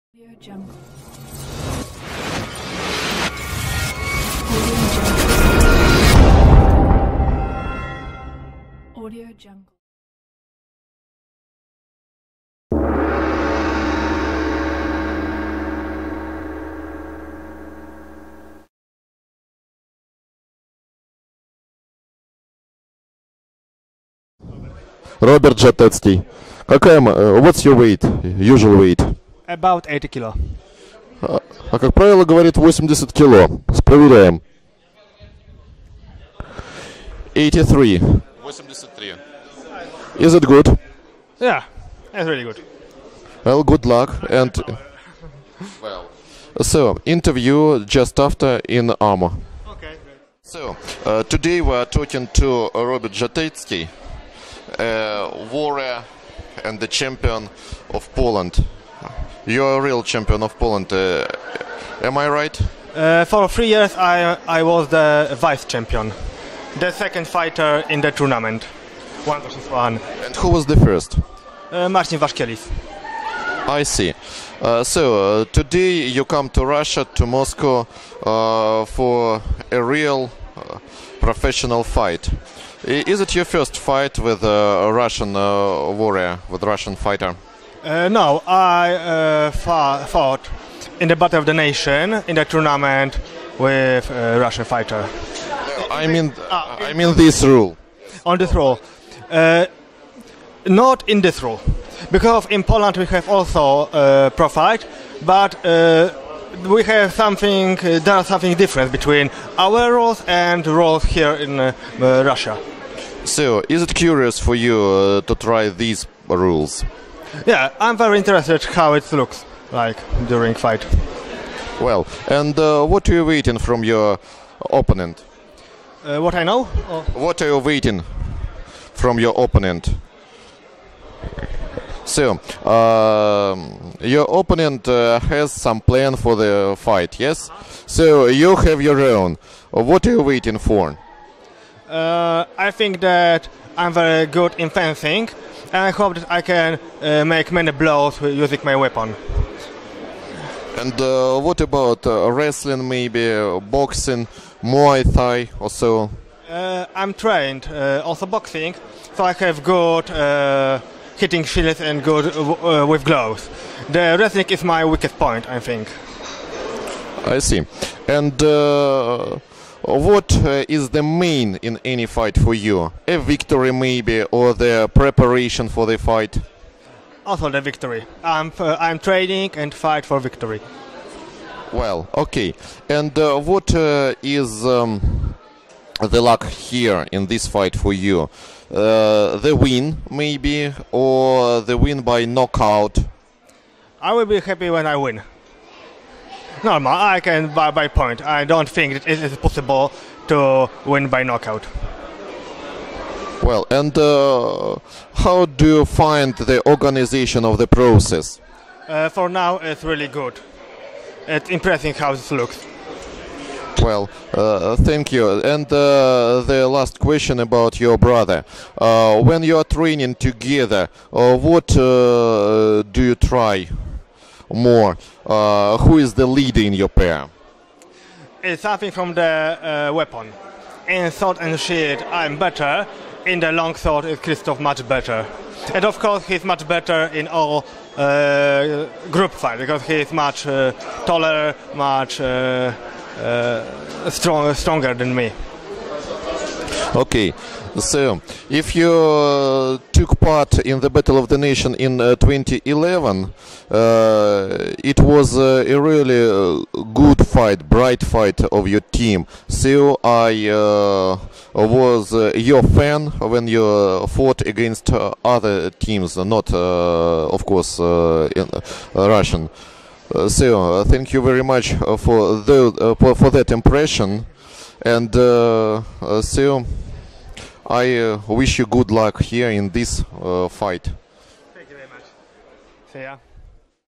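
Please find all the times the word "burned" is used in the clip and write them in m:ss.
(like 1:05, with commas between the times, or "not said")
not said.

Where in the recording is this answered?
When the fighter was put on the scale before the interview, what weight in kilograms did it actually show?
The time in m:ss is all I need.
0:37.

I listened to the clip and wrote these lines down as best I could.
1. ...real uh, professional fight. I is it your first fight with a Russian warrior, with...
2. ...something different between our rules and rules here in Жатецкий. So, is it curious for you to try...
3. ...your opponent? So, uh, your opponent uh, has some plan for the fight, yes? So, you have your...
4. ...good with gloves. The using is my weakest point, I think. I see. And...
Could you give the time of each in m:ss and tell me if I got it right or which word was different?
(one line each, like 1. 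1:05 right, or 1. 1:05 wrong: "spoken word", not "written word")
1. 1:19 right
2. 1:48 wrong: "Russia", not "Жатецкий"
3. 2:09 right
4. 2:42 wrong: "wrestling", not "using".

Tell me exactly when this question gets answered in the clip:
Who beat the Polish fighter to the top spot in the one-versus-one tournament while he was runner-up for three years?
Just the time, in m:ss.
1:11.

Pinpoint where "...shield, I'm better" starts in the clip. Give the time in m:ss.
3:51.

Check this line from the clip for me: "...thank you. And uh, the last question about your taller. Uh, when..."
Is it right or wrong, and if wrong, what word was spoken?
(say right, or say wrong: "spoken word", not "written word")
wrong: "brother", not "taller".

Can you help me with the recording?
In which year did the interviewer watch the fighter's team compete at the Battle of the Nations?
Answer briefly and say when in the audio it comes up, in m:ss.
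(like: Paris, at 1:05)
2011, at 4:12.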